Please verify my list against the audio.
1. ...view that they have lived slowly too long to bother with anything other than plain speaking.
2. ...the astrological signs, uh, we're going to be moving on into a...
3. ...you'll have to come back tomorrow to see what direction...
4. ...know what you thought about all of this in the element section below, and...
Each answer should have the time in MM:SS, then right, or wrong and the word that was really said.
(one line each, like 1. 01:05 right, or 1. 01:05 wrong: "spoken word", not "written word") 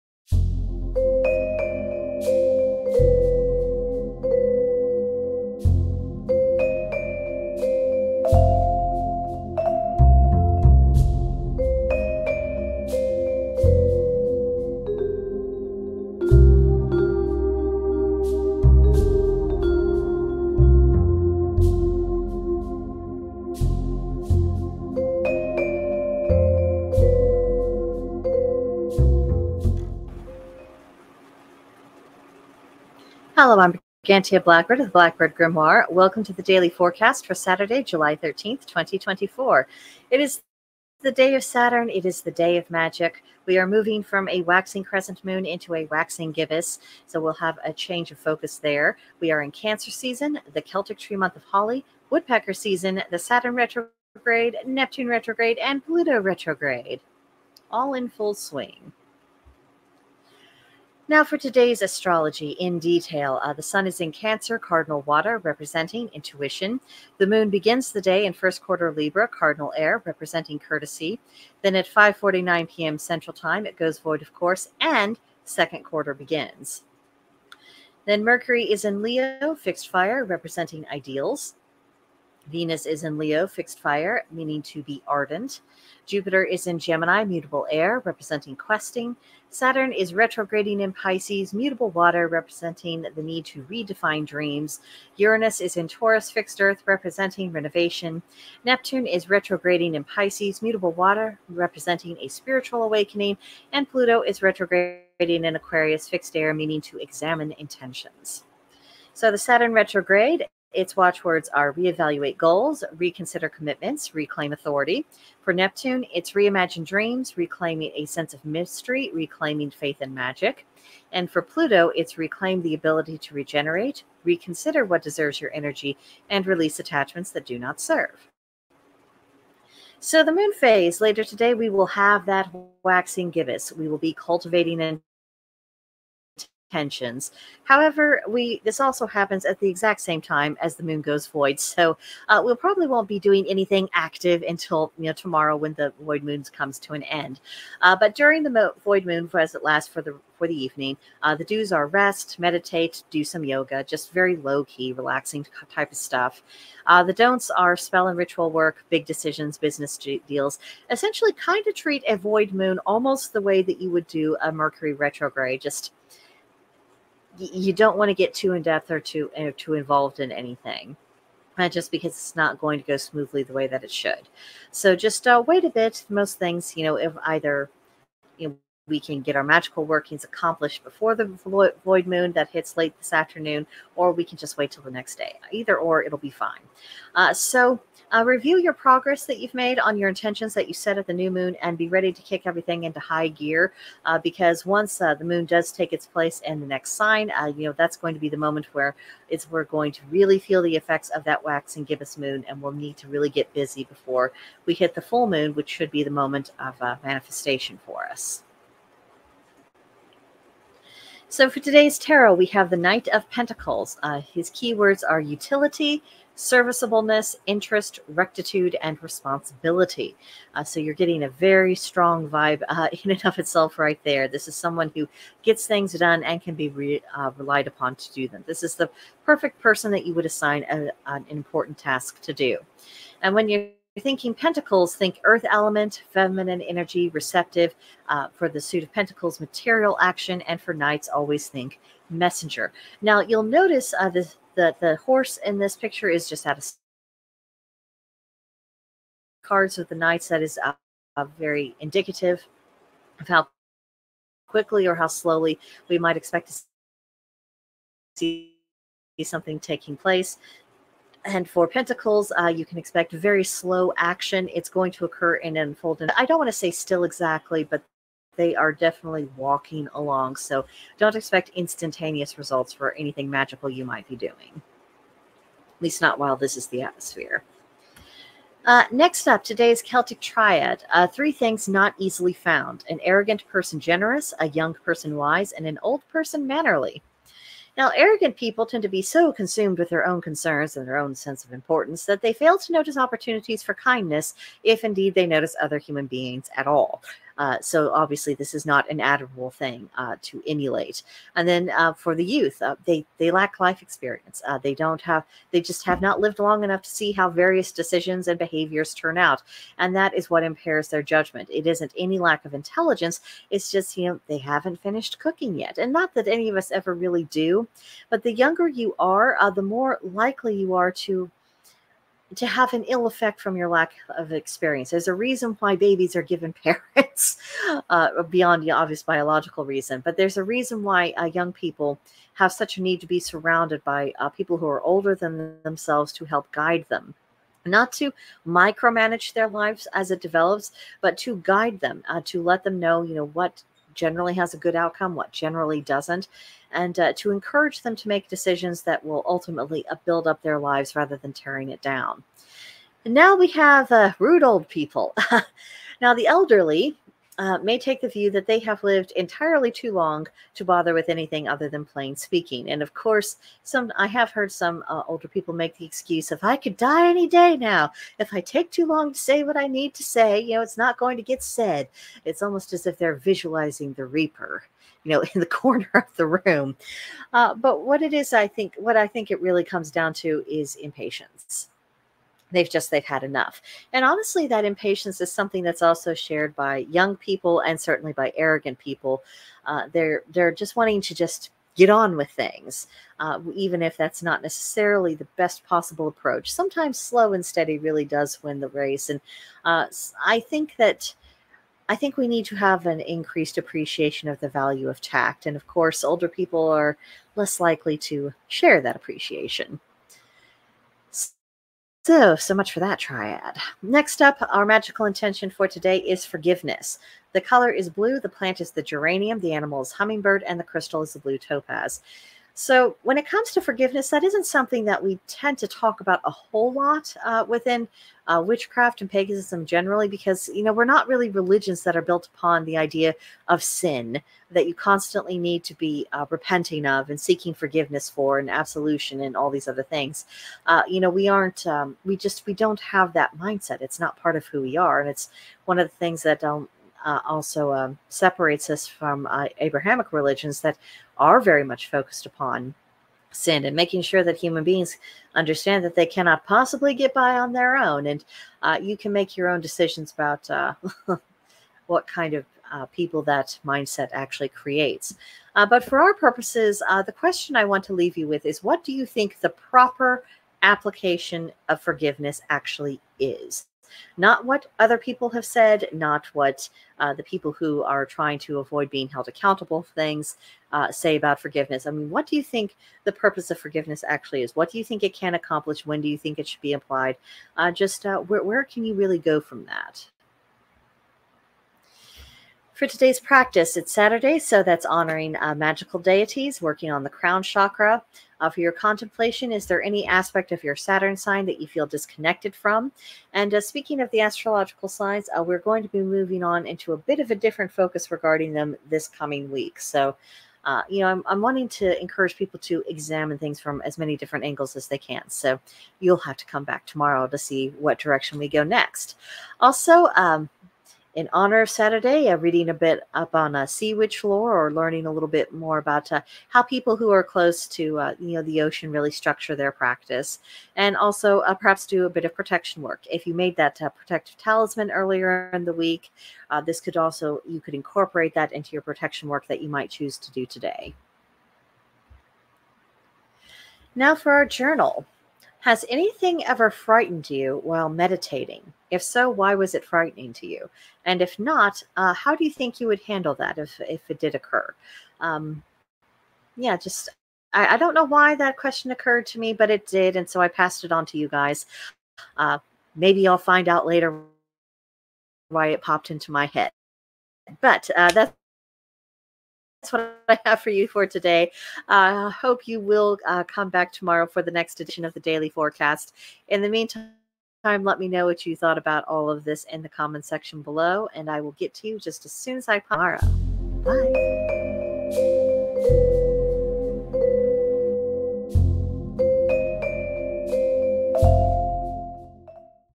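1. 05:58 wrong: "entirely", not "slowly"
2. 08:24 right
3. 08:35 right
4. 09:38 wrong: "comment", not "element".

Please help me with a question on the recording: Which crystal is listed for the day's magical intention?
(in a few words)
Blue topaz.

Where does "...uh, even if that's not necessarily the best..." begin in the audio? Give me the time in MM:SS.
06:33.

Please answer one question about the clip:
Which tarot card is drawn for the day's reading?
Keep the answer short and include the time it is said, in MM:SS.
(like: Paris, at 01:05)
Knight of Pentacles, at 03:32.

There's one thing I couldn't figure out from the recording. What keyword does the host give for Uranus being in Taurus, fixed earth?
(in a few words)
Renovation.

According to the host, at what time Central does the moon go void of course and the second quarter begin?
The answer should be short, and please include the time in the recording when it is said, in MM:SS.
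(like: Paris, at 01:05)
5:49 p.m., at 01:11.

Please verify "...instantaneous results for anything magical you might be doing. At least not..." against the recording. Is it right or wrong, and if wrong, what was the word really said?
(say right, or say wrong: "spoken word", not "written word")
right.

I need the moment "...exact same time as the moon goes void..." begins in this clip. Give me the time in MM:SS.
02:19.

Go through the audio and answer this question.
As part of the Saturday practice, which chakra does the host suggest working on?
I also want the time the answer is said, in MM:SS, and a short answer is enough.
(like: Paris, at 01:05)
Crown chakra, at 08:17.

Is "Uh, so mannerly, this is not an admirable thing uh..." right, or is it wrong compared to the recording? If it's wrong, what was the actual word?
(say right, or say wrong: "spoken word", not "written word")
wrong: "obviously", not "mannerly".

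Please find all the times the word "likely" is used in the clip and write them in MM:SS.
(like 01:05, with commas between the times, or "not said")
05:20, 06:47.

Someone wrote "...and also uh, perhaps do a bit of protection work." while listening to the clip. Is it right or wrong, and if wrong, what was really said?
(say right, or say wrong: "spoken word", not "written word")
right.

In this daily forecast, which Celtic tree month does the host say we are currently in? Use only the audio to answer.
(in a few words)
Holly.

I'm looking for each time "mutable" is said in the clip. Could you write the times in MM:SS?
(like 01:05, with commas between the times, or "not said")
01:27, 01:31, 01:40.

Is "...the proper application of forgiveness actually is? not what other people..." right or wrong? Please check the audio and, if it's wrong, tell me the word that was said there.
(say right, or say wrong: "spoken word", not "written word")
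right.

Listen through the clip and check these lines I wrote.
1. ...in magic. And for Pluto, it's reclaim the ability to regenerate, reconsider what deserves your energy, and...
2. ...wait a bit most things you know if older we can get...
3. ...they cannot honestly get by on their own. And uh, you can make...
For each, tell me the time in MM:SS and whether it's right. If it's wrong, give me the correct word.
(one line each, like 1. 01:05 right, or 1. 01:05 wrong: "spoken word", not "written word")
1. 02:00 right
2. 02:55 wrong: "either", not "older"
3. 07:35 wrong: "possibly", not "honestly".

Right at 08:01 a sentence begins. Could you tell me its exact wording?
I mean, what do you think the purpose of forgiveness actually is?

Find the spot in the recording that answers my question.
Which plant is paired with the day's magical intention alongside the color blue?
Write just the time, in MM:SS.
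06:58.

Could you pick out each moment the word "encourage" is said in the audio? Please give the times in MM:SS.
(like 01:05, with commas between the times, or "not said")
05:47, 08:32.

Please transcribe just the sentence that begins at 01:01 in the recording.
Now, for today's astrology in detail, uh, the sun is in Cancer, cardinal water, representing intuition.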